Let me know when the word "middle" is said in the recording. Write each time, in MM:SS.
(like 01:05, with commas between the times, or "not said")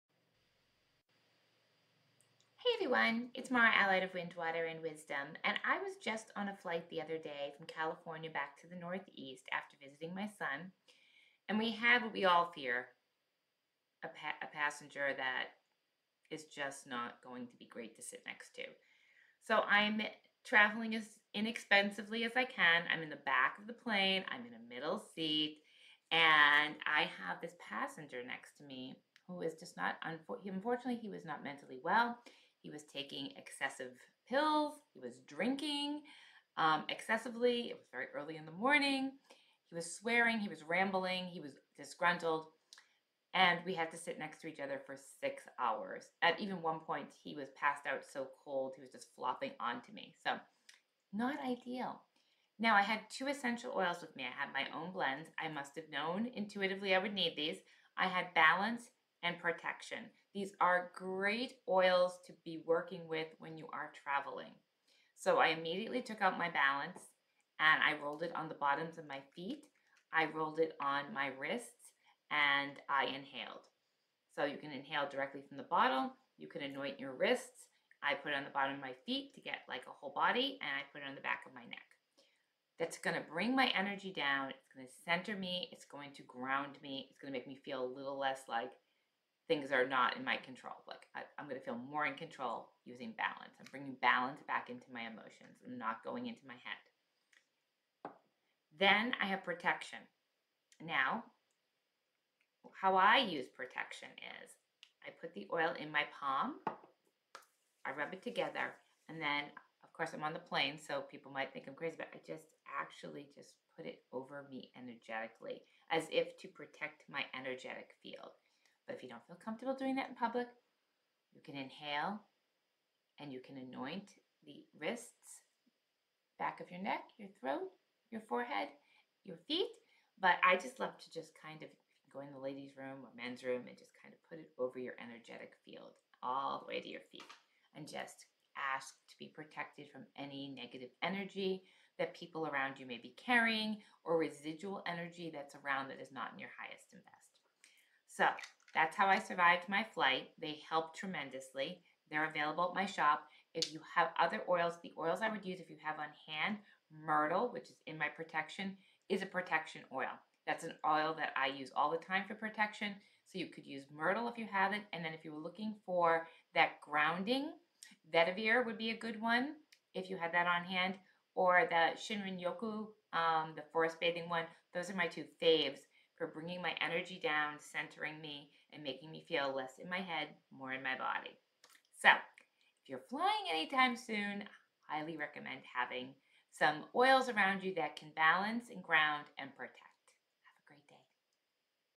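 00:24.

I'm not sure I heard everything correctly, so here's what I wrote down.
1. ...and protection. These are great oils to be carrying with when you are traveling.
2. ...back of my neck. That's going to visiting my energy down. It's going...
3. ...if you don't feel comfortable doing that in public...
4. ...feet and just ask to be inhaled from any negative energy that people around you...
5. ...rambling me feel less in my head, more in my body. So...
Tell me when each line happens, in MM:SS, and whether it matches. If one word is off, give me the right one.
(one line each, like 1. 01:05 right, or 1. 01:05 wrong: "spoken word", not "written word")
1. 00:59 wrong: "working", not "carrying"
2. 01:21 wrong: "bring", not "visiting"
3. 01:58 right
4. 02:17 wrong: "protected", not "inhaled"
5. 02:58 wrong: "making", not "rambling".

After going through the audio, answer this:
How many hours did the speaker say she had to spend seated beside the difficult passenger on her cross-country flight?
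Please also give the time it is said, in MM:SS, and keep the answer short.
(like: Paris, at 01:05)
6, at 00:45.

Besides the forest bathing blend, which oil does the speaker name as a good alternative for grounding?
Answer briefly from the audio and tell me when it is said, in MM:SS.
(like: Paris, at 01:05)
Vetiver, at 02:48.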